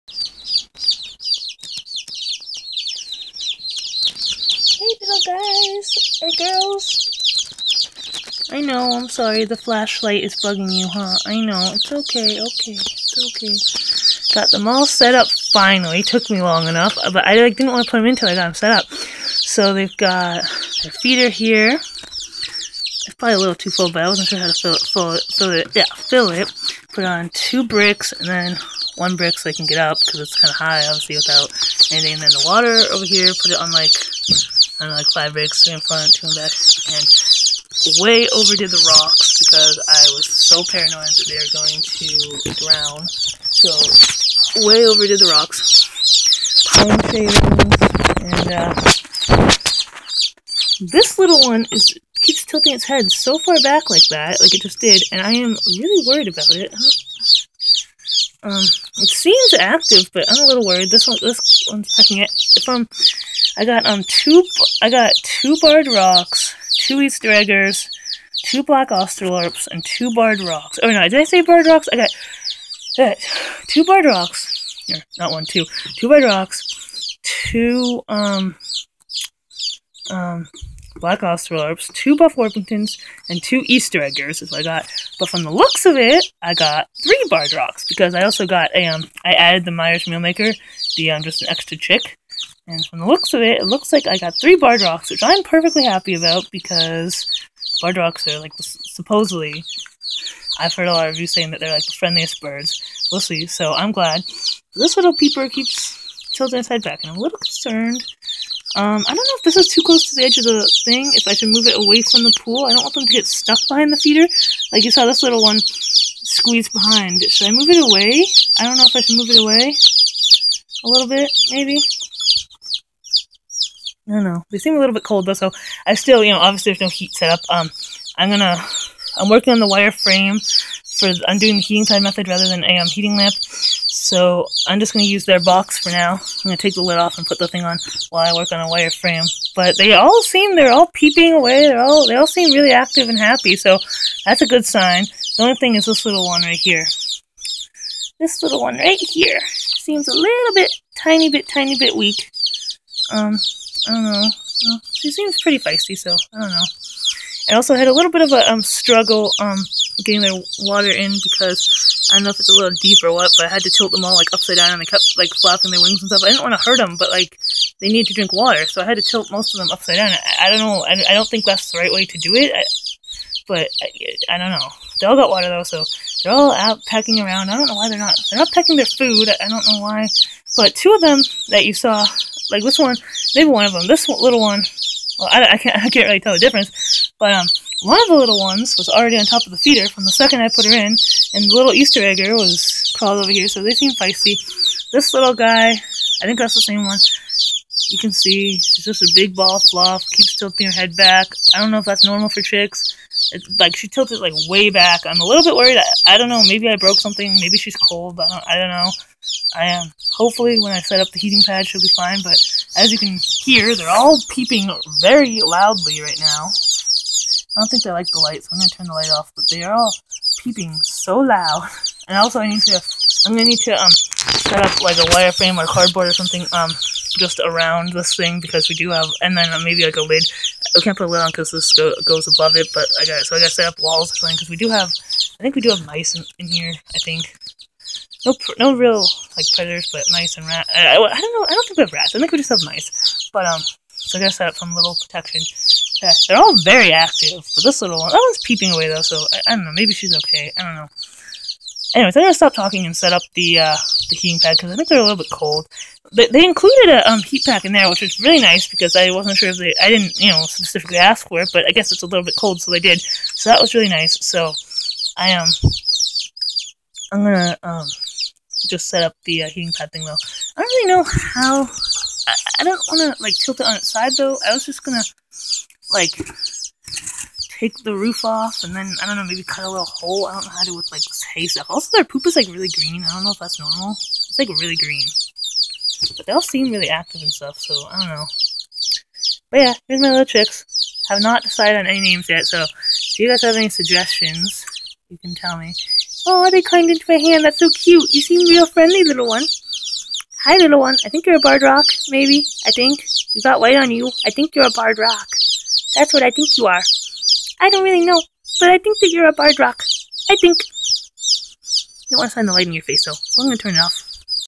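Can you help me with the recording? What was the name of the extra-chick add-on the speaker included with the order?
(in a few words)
Myers Meal Maker.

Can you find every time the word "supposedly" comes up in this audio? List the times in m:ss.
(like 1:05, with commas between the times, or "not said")
1:38.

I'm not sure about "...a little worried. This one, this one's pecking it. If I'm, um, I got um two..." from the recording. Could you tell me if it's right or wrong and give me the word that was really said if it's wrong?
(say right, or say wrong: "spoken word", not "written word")
right.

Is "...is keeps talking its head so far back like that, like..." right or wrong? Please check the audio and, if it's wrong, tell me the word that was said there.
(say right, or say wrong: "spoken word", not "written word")
wrong: "tilting", not "talking".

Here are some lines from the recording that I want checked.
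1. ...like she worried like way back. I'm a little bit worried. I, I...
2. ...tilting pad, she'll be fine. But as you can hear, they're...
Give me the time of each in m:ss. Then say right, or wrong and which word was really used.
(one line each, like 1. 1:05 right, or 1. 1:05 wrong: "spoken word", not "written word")
1. 3:23 wrong: "tilted", not "worried"
2. 3:31 wrong: "heating", not "tilting".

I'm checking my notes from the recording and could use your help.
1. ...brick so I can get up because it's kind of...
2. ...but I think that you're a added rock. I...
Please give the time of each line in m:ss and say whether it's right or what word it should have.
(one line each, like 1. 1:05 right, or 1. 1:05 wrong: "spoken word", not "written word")
1. 0:29 right
2. 5:08 wrong: "barred", not "added".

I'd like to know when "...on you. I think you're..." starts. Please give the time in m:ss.
5:03.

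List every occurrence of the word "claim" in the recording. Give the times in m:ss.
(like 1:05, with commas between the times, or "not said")
not said.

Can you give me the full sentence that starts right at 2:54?
They all got water though, so they're all out pecking around.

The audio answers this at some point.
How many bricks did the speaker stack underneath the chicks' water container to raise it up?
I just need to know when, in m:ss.
0:35.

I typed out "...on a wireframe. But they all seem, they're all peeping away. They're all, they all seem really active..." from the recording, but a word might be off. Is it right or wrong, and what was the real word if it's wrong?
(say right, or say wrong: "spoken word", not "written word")
right.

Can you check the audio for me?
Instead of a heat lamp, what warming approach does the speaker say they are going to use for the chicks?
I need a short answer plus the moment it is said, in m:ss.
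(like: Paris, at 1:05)
heating side method, at 2:11.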